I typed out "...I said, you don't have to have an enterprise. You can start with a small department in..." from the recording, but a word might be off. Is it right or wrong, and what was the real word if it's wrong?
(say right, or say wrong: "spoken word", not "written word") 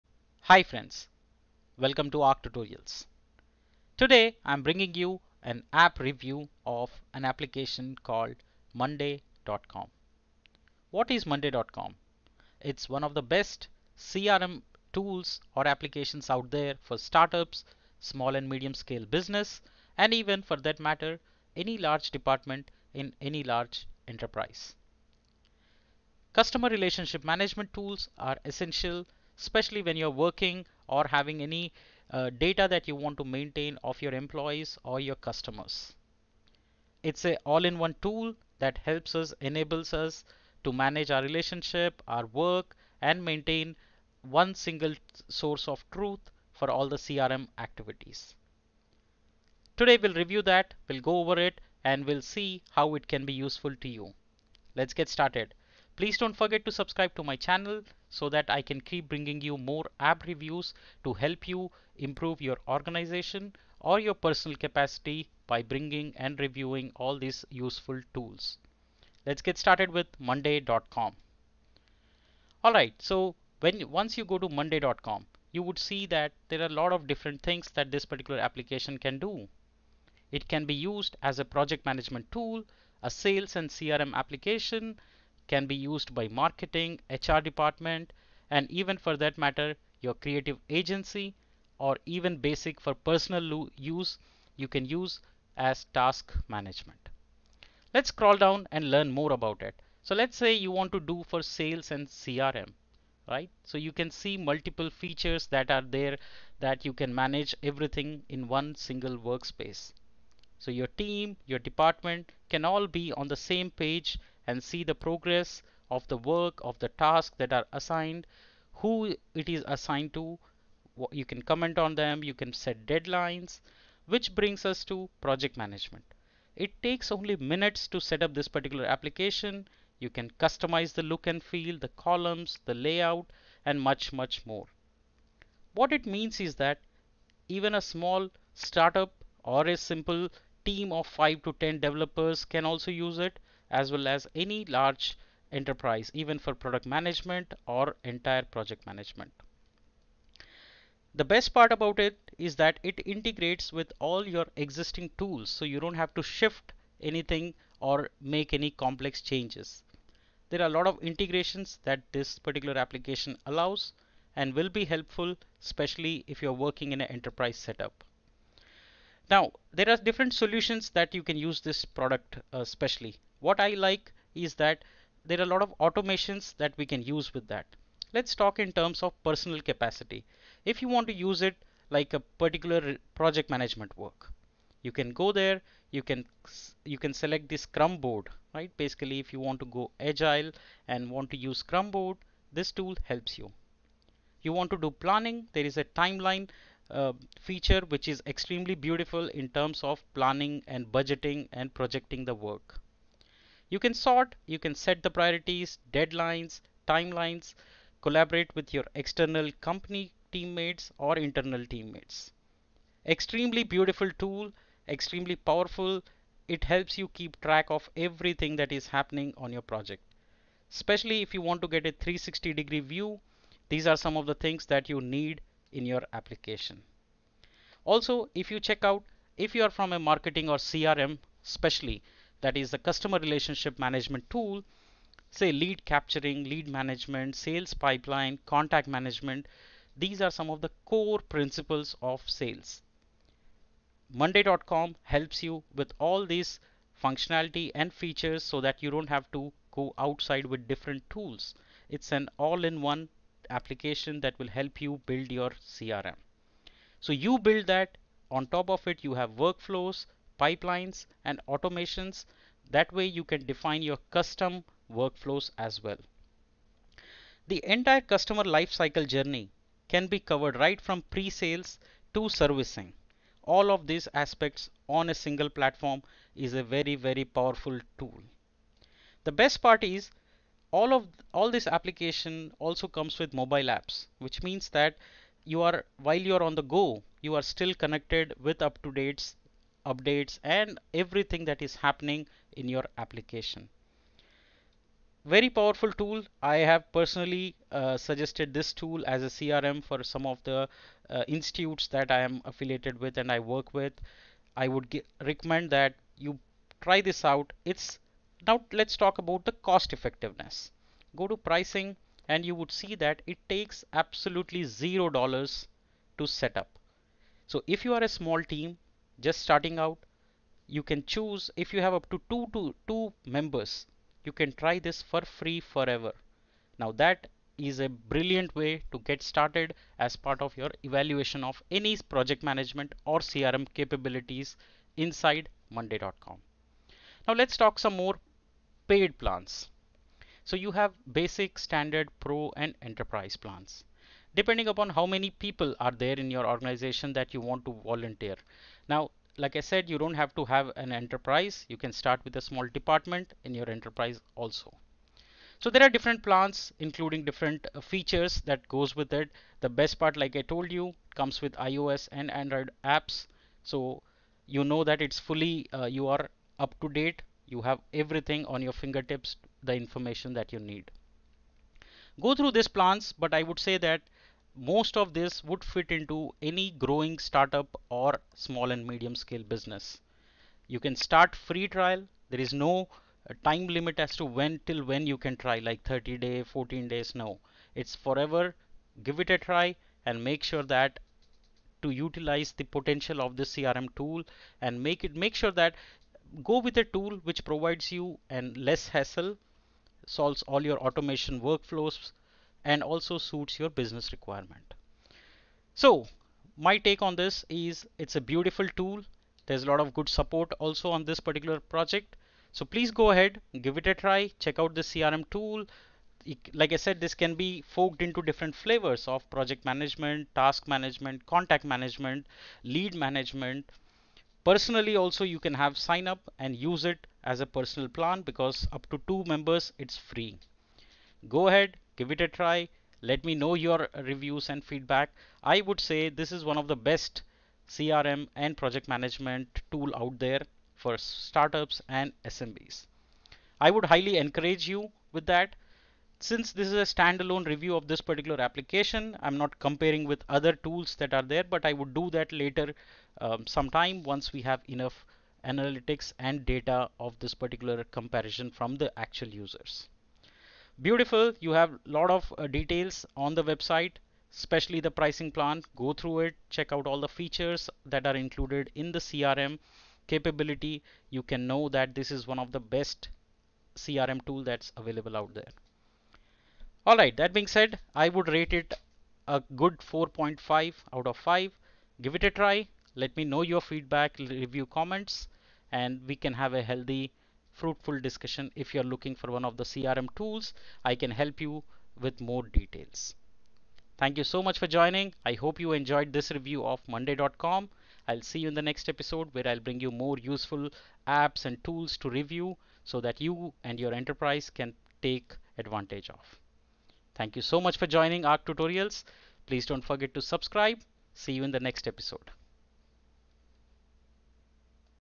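right.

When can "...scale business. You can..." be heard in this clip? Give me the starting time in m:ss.
6:19.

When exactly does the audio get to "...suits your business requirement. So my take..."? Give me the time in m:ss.
6:43.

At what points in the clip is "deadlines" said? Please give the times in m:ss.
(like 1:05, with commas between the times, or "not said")
2:02, 3:25.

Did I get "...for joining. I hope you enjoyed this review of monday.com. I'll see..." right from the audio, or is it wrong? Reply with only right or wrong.
right.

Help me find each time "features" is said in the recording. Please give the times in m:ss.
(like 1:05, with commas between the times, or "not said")
1:44, 3:17, 4:07, 5:57, 7:47.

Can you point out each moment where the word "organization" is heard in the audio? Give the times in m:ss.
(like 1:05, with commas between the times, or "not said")
1:02, 5:46.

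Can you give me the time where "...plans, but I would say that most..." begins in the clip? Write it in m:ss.
6:12.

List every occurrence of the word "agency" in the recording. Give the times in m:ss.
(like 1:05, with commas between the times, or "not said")
1:30.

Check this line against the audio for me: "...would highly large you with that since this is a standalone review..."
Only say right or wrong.
wrong.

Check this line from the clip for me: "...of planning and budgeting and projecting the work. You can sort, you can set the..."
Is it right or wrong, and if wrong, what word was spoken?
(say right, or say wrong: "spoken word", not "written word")
right.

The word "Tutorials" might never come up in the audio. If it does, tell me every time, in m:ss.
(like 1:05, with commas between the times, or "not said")
0:02, 8:28.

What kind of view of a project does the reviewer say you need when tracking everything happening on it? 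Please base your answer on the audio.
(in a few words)
360 degree view.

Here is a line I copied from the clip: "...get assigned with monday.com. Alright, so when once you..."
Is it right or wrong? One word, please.
wrong.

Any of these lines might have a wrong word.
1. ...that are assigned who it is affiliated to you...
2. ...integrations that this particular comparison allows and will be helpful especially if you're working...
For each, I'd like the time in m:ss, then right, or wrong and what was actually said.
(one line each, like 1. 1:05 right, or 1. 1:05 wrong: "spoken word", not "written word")
1. 1:57 wrong: "assigned", not "affiliated"
2. 2:41 wrong: "application", not "comparison".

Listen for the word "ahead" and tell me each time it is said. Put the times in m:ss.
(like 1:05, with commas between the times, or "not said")
6:53, 7:11.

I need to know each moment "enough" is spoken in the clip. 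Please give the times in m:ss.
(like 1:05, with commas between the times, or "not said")
7:34.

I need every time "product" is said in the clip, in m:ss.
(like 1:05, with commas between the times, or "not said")
2:26, 2:51.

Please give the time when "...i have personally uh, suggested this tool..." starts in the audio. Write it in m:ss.
4:56.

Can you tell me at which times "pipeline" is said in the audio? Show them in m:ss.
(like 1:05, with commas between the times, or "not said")
3:57, 4:20.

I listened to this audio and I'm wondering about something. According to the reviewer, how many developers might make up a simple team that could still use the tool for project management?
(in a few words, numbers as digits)
5 to 10.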